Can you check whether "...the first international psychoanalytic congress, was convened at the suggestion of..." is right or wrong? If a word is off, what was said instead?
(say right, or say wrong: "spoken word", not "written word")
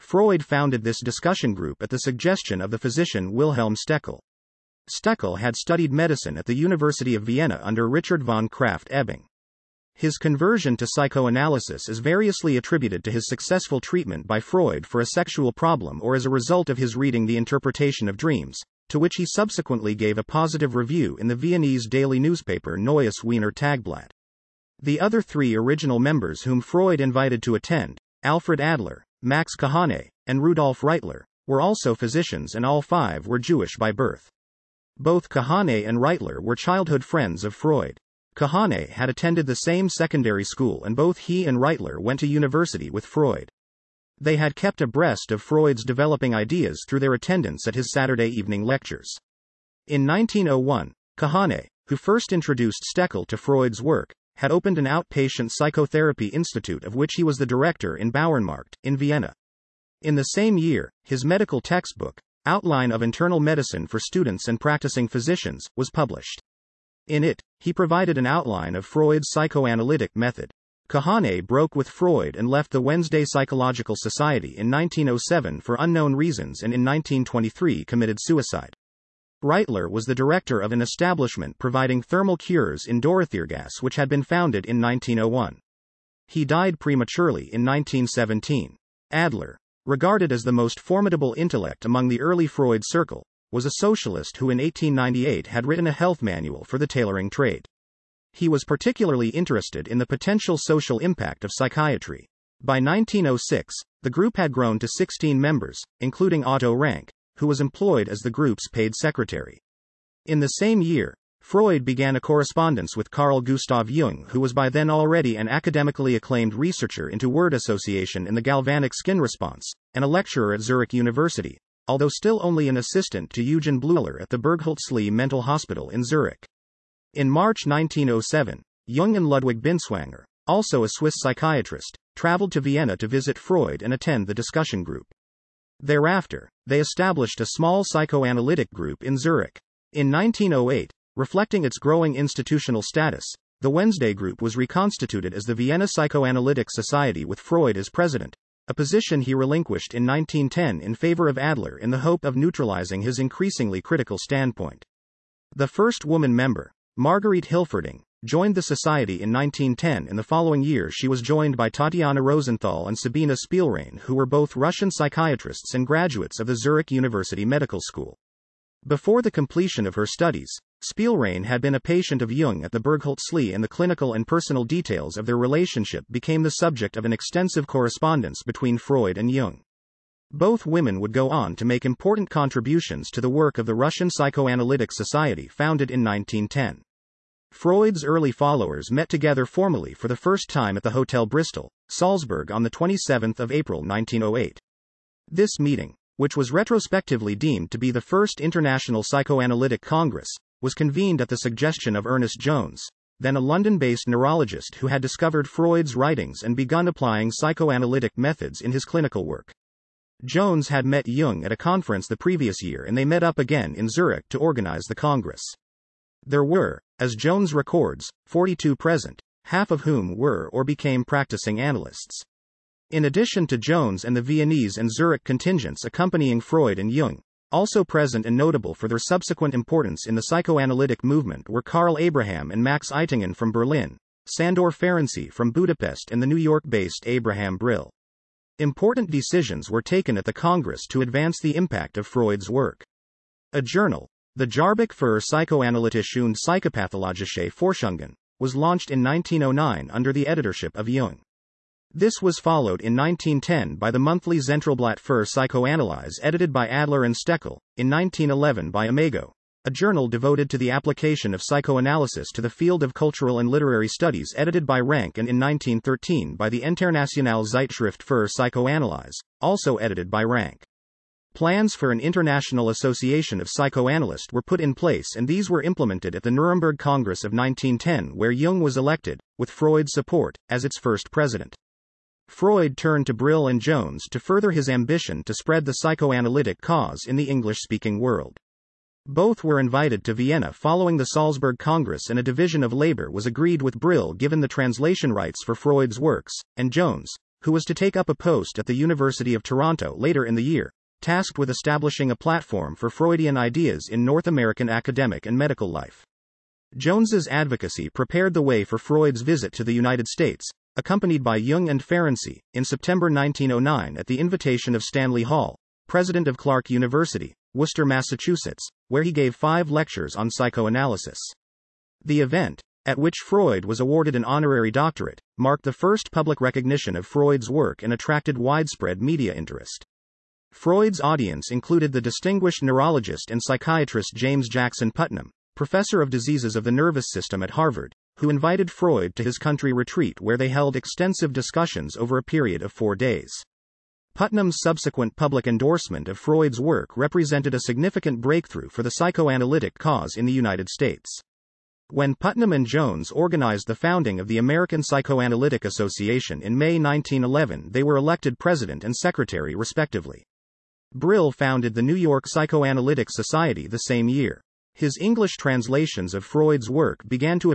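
right.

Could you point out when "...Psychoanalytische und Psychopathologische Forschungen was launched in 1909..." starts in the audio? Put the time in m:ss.
4:05.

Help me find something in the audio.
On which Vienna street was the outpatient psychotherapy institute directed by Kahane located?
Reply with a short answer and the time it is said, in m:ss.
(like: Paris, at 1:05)
Bauernmarkt, at 0:58.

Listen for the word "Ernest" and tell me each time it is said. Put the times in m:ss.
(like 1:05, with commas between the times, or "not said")
3:22.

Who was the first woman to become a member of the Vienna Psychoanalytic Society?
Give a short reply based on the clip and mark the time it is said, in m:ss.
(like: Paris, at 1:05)
Marguerite Hilferding, at 2:36.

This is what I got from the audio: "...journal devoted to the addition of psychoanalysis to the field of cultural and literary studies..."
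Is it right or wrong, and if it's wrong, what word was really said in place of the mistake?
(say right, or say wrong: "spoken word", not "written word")
wrong: "application", not "addition".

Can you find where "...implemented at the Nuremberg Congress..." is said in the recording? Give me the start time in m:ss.
4:35.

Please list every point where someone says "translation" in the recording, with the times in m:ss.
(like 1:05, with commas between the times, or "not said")
4:54, 6:05.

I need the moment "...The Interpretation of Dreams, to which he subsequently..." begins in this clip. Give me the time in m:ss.
0:17.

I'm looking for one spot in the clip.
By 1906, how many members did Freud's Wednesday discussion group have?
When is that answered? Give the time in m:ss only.
1:44.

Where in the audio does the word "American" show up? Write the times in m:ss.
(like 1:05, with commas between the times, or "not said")
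5:04, 5:54.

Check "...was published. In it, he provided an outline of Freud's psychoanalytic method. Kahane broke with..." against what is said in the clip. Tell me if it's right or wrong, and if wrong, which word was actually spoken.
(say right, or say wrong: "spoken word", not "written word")
right.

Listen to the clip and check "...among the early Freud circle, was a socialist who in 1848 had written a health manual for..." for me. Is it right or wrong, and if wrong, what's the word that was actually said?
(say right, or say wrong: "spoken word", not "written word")
wrong: "1898", not "1848".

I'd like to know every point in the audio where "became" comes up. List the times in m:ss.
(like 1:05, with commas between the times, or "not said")
2:56, 3:40.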